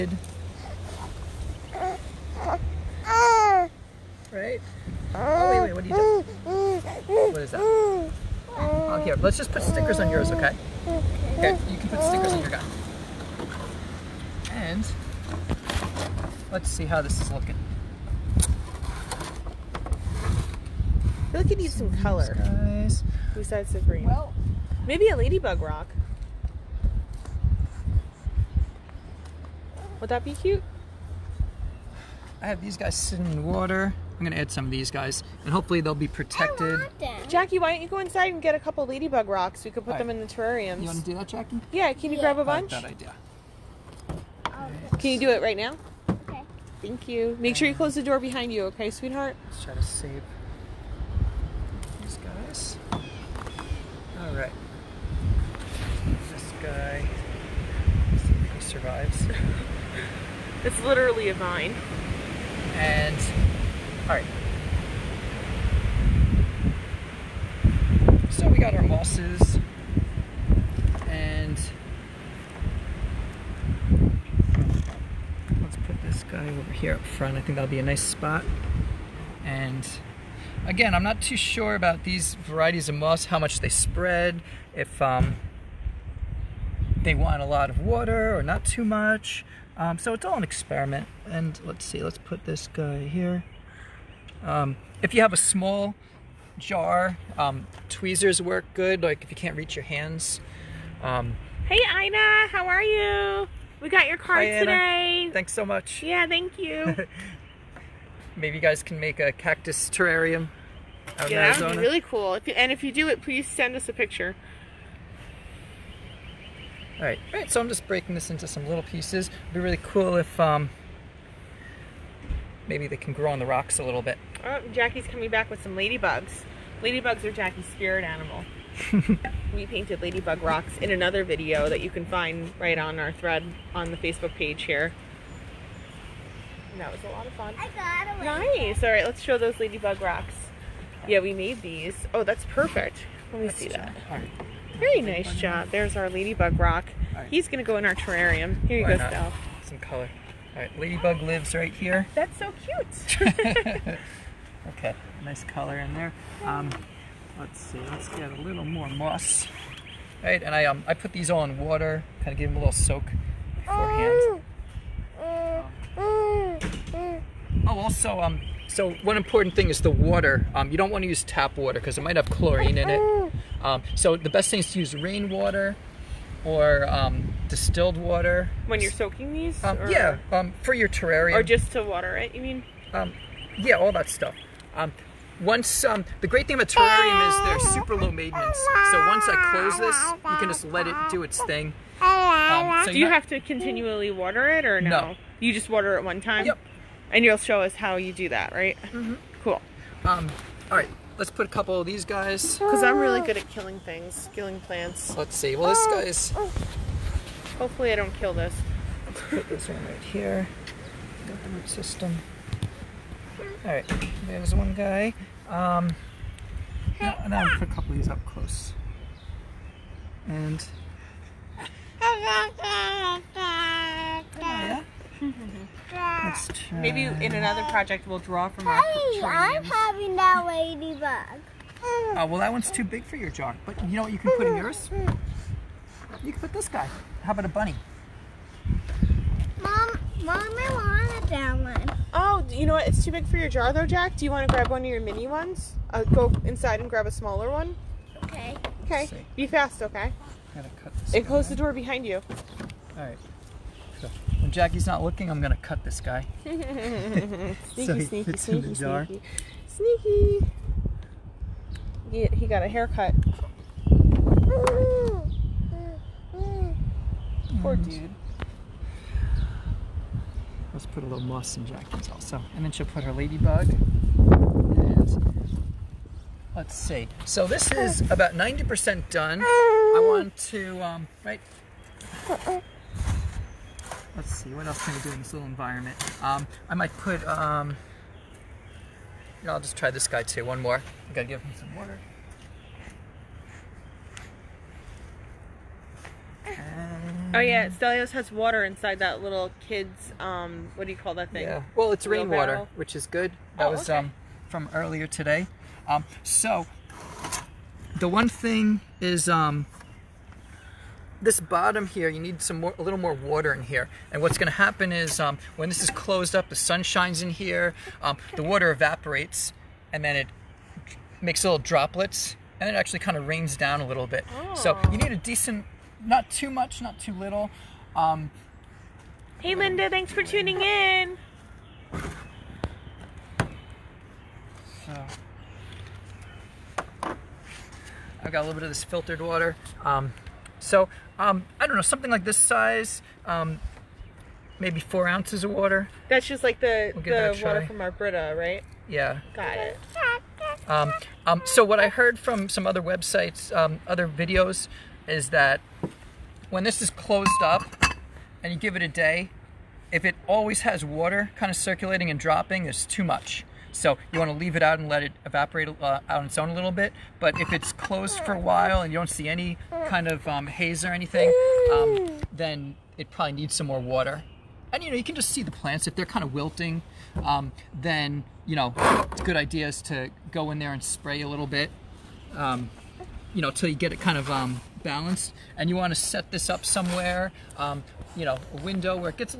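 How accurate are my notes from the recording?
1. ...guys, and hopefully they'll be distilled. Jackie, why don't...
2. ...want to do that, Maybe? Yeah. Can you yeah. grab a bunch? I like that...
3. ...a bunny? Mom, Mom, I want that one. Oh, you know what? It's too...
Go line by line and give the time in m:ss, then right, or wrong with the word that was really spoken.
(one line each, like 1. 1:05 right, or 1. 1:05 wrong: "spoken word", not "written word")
1. 0:34 wrong: "protected", not "distilled"
2. 0:40 wrong: "Jackie", not "Maybe"
3. 3:57 right.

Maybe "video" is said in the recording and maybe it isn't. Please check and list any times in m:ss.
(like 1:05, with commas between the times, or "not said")
2:11, 5:54.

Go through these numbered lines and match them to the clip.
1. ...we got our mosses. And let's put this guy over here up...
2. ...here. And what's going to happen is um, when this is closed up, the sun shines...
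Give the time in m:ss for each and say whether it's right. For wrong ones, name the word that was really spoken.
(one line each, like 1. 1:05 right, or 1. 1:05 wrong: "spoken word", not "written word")
1. 1:08 right
2. 5:13 right.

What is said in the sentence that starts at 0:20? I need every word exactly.
I feel like it needs some color.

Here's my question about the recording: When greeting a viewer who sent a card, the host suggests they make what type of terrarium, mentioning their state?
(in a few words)
Cactus terrarium.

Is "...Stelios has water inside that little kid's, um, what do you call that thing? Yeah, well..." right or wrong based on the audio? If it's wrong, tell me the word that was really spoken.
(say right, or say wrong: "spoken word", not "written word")
right.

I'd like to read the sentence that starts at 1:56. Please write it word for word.
All right, All right, so I'm just breaking this into some little pieces.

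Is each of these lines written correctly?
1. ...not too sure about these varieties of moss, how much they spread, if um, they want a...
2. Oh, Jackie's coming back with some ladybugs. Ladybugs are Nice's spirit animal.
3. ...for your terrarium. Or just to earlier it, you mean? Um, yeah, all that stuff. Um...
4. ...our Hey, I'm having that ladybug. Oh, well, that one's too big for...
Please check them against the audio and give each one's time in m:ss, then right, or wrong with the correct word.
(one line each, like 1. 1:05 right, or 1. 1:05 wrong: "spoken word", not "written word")
1. 1:21 right
2. 2:04 wrong: "Jackie", not "Nice"
3. 3:00 wrong: "water", not "earlier"
4. 3:48 right.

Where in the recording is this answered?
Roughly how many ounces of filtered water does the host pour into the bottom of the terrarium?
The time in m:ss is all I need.
5:44.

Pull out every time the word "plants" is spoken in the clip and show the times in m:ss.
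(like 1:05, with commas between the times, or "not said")
3:24, 6:15.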